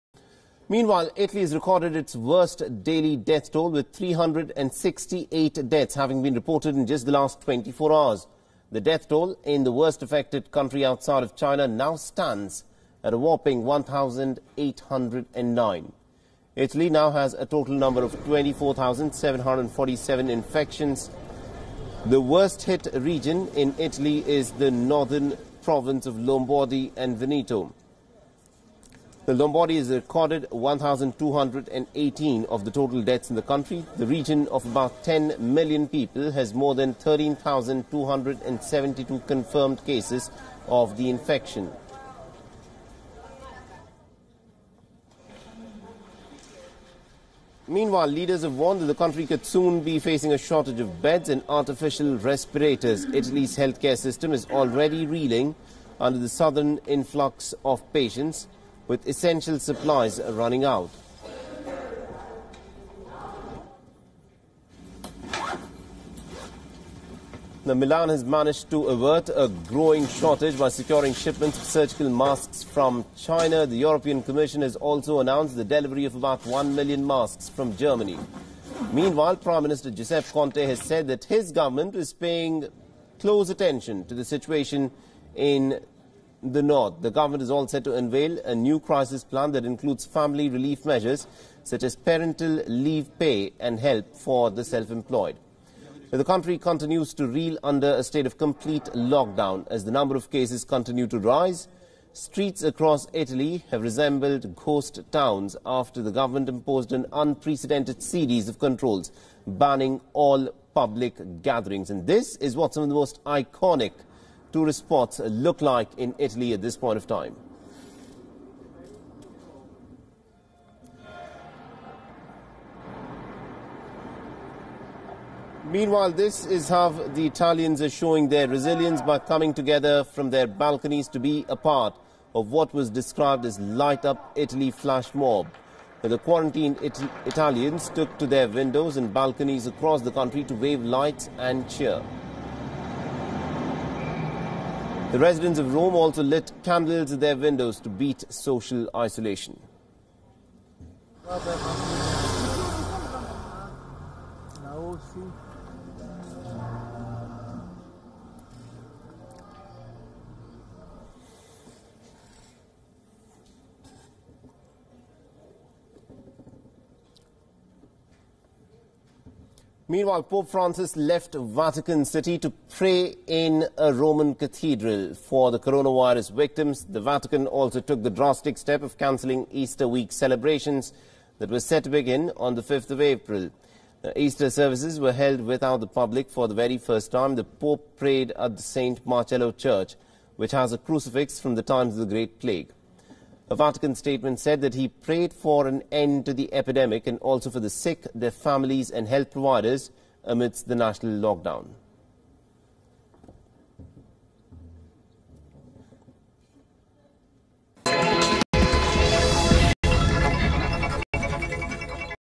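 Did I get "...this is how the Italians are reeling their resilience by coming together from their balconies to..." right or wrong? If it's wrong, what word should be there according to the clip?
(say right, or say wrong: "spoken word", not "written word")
wrong: "showing", not "reeling".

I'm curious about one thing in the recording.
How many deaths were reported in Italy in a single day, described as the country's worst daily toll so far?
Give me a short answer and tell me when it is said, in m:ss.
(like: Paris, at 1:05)
368, at 0:03.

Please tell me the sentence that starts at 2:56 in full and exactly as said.
The Vatican also took the drastic step of cancelling Easter week celebrations that were set to begin on the 5th of April.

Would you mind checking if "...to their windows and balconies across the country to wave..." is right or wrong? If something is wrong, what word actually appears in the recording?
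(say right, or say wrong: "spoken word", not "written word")
right.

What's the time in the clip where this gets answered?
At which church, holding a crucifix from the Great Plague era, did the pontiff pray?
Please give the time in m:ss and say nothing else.
3:08.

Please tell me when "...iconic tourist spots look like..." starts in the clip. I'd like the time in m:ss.
1:53.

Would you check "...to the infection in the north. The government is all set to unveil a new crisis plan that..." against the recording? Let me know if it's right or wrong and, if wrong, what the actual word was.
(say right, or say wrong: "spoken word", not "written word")
wrong: "situation", not "infection".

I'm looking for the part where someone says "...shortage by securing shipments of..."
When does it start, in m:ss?
1:10.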